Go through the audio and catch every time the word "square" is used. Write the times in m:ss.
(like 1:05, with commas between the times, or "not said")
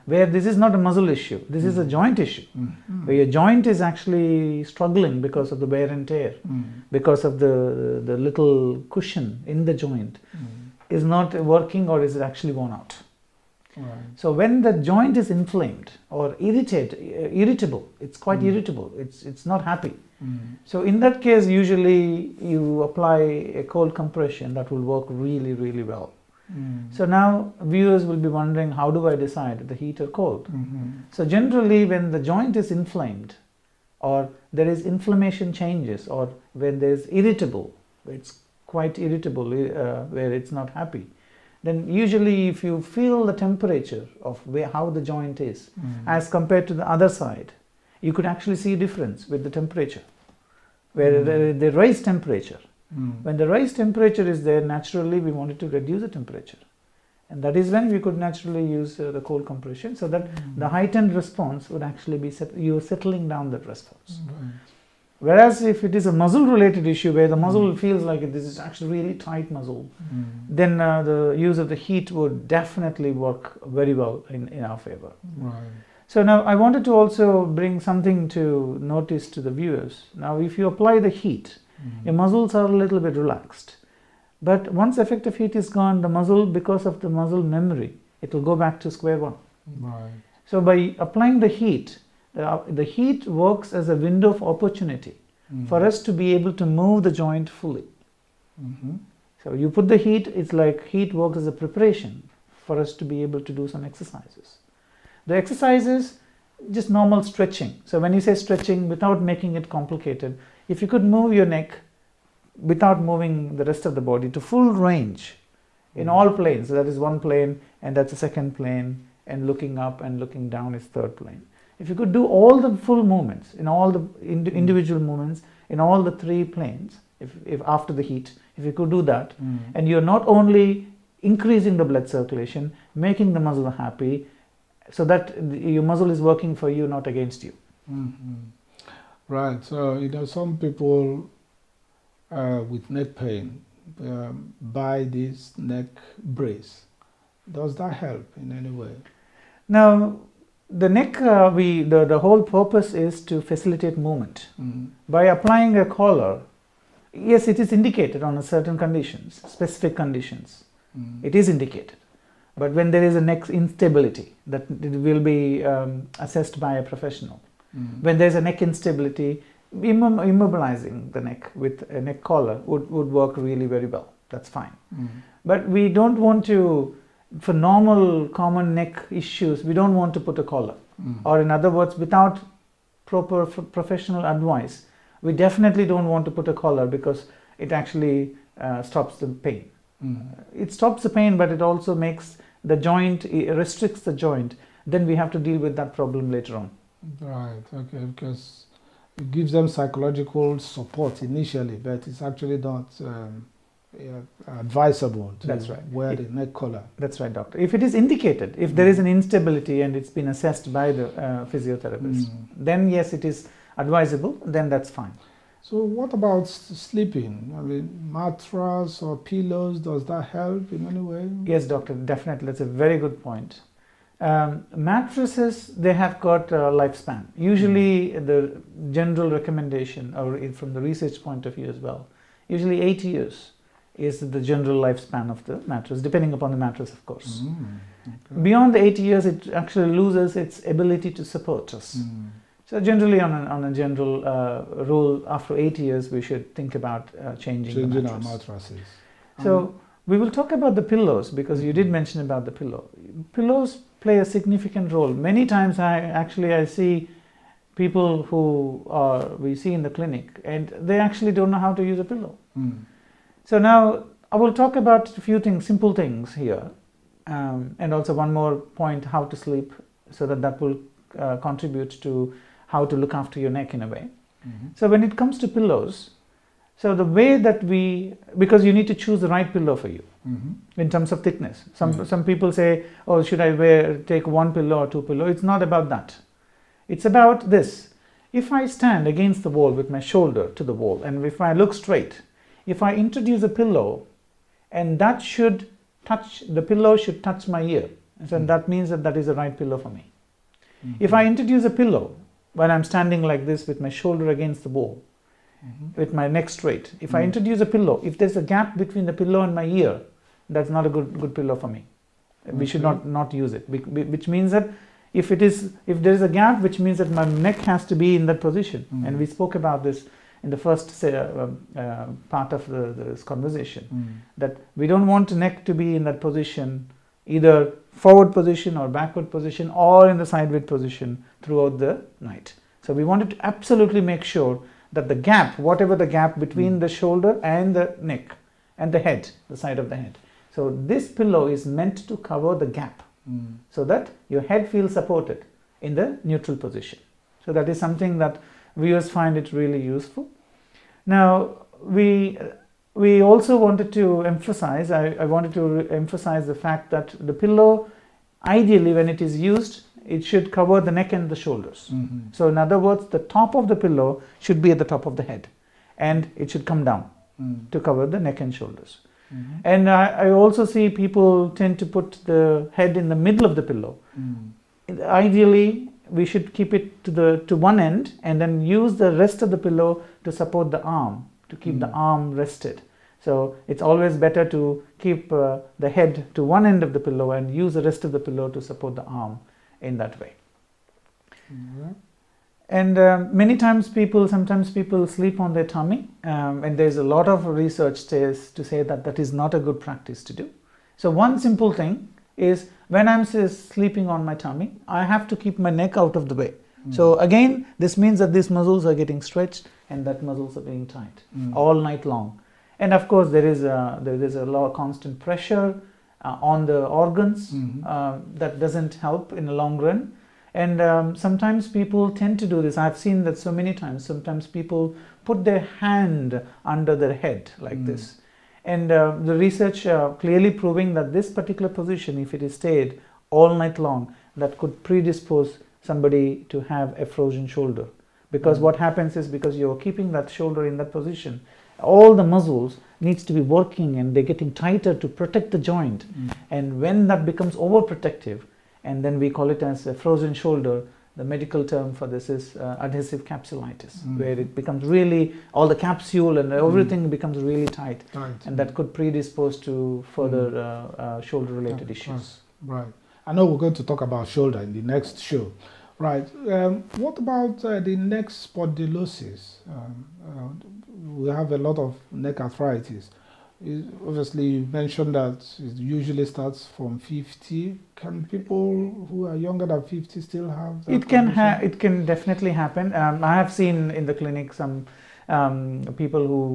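1:28.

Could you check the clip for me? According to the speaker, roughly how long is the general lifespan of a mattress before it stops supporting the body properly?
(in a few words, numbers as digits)
8 years.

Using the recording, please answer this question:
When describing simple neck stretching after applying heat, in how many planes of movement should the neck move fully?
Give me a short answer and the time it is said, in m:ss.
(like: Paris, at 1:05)
3, at 2:06.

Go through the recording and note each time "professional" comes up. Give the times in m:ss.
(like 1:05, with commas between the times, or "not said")
2:46, 3:03.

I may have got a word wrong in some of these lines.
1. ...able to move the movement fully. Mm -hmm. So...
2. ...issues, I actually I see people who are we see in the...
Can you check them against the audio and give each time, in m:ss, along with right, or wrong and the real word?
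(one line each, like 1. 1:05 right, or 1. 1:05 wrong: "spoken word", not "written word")
1. 1:36 wrong: "joint", not "movement"
2. 4:15 wrong: "times", not "issues".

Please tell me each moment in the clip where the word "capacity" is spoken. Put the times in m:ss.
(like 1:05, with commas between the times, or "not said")
not said.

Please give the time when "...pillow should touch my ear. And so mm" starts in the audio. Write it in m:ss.
4:56.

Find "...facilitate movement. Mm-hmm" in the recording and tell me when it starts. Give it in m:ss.
2:33.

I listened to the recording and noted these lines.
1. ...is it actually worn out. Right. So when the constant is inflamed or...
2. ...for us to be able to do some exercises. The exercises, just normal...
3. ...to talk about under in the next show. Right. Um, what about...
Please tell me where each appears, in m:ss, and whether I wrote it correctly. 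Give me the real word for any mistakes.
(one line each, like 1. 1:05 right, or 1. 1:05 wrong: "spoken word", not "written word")
1. 0:12 wrong: "joint", not "constant"
2. 1:42 right
3. 7:43 wrong: "shoulder", not "under".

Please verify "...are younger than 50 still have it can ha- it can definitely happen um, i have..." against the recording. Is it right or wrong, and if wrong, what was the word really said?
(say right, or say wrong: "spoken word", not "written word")
right.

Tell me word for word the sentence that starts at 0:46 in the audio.
as compared to the other side, you could actually see a difference with the temperature.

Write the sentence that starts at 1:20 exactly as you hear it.
Now if you apply the heat, mm.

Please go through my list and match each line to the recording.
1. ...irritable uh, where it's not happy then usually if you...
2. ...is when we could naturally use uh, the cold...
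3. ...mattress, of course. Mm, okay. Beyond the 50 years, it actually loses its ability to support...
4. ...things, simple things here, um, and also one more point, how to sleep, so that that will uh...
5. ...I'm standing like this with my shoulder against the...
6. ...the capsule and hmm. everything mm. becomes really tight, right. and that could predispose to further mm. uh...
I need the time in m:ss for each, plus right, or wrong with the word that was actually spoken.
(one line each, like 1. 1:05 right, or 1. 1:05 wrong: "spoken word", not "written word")
1. 0:39 right
2. 0:57 right
3. 3:56 wrong: "80", not "50"
4. 4:25 right
5. 5:02 right
6. 7:35 right.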